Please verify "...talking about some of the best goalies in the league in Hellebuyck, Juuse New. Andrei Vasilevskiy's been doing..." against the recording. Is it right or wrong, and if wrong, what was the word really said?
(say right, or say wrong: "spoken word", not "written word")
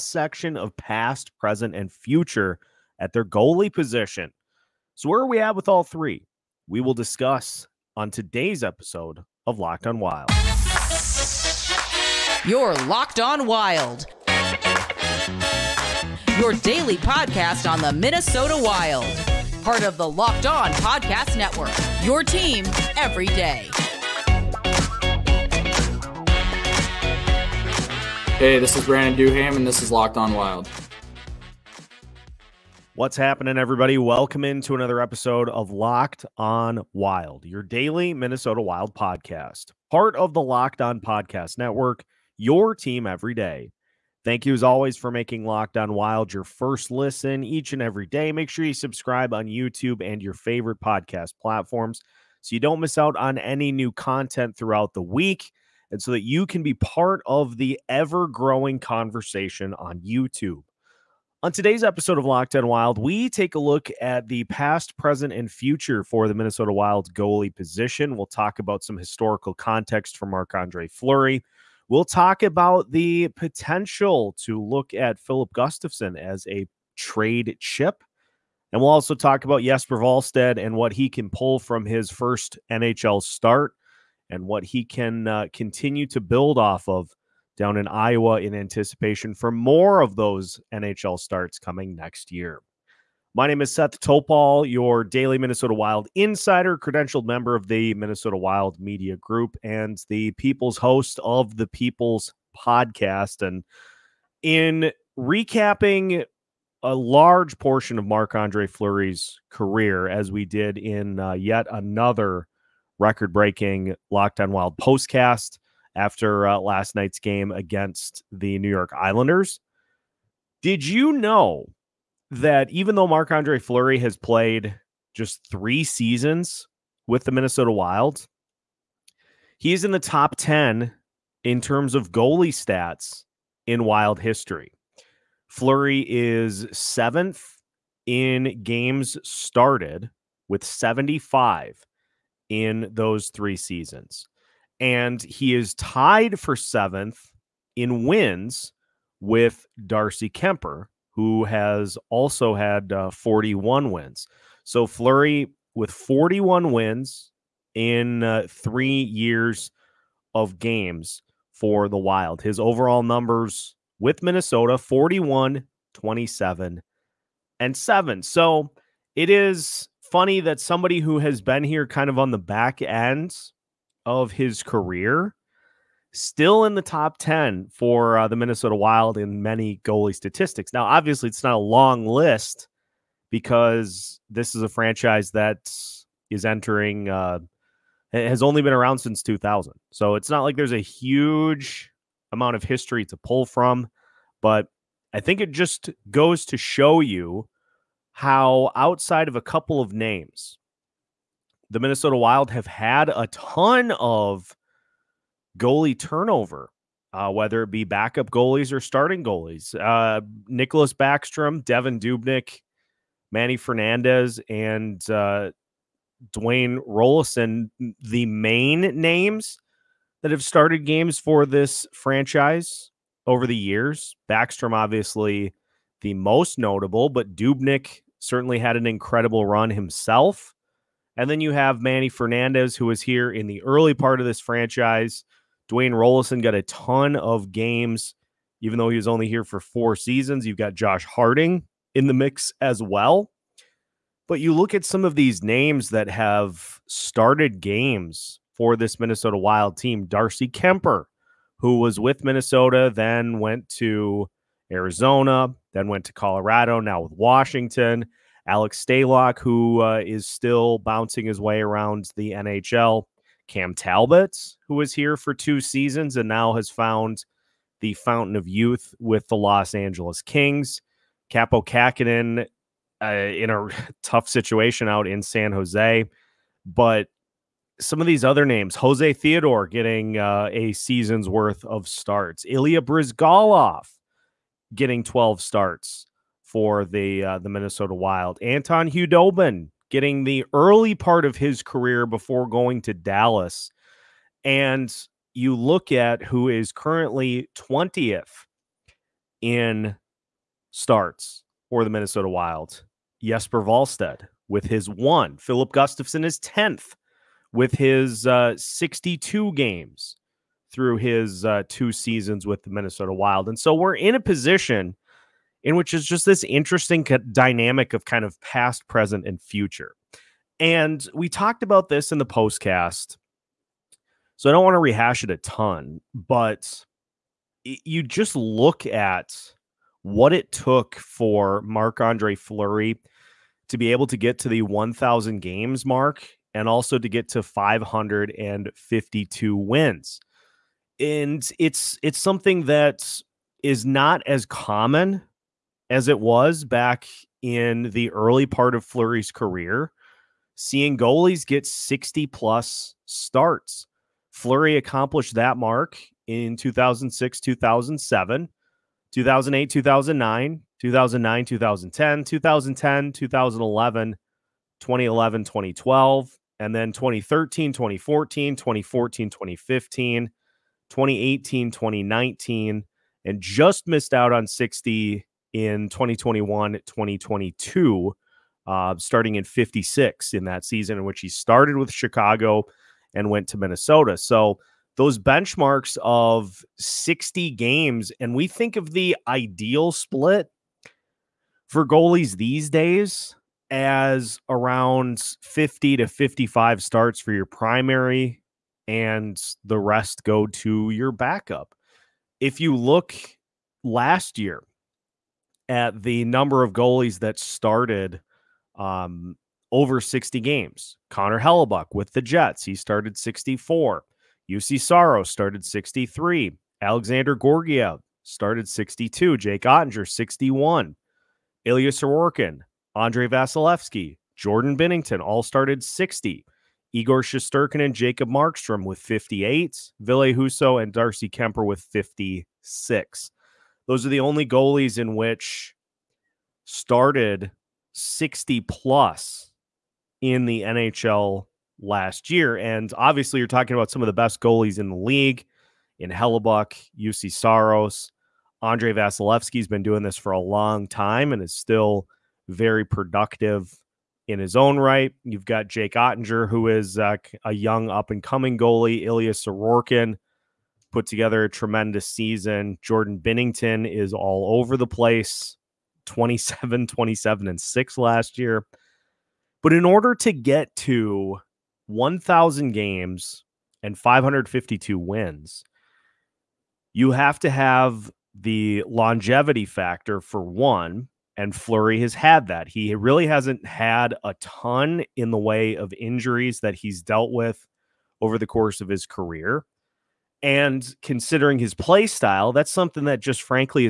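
wrong: "Saros", not "New".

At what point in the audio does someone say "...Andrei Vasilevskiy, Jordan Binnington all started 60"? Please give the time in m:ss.
7:02.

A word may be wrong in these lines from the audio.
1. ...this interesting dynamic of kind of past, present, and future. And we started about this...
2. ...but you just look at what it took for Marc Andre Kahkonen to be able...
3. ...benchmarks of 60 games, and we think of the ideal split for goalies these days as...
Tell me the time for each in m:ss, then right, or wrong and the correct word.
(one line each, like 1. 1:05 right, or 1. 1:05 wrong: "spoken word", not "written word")
1. 5:16 wrong: "talked", not "started"
2. 5:26 wrong: "Fleury", not "Kahkonen"
3. 6:25 right.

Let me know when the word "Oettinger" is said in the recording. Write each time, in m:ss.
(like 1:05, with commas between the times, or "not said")
6:59, 7:35.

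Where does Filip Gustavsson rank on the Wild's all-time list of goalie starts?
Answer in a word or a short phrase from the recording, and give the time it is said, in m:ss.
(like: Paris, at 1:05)
10th, at 5:06.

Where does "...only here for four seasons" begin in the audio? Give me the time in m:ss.
3:59.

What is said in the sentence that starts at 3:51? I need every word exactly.
And then you have Manny Fernandez, who was here in the early part of this franchise.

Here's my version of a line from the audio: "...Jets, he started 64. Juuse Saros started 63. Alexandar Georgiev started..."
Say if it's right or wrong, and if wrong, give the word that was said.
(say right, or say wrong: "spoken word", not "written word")
right.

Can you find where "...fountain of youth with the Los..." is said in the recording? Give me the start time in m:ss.
4:27.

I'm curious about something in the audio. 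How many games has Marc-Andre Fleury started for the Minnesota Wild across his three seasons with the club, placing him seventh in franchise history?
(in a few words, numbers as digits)
75.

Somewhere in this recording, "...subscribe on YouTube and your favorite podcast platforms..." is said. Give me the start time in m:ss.
0:48.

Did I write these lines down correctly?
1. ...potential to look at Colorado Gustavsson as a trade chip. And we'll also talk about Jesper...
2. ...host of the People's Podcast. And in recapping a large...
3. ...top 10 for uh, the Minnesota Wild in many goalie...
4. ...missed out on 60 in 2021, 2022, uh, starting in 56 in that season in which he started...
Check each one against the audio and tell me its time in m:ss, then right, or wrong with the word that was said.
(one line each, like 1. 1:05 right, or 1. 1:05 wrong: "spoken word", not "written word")
1. 1:13 wrong: "Filip", not "Colorado"
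2. 1:40 right
3. 2:56 right
4. 6:13 right.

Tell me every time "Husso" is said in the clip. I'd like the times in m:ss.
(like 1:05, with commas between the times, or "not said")
7:10.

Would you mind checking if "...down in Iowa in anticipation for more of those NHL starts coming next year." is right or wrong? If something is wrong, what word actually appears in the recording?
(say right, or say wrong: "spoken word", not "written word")
right.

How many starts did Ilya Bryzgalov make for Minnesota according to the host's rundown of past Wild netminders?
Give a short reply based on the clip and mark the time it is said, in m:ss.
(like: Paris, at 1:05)
12, at 4:45.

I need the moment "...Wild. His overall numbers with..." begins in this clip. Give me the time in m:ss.
2:41.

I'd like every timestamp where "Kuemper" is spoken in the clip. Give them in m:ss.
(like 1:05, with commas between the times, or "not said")
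2:30, 4:10, 7:11.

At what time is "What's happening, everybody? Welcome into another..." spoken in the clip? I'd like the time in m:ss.
0:32.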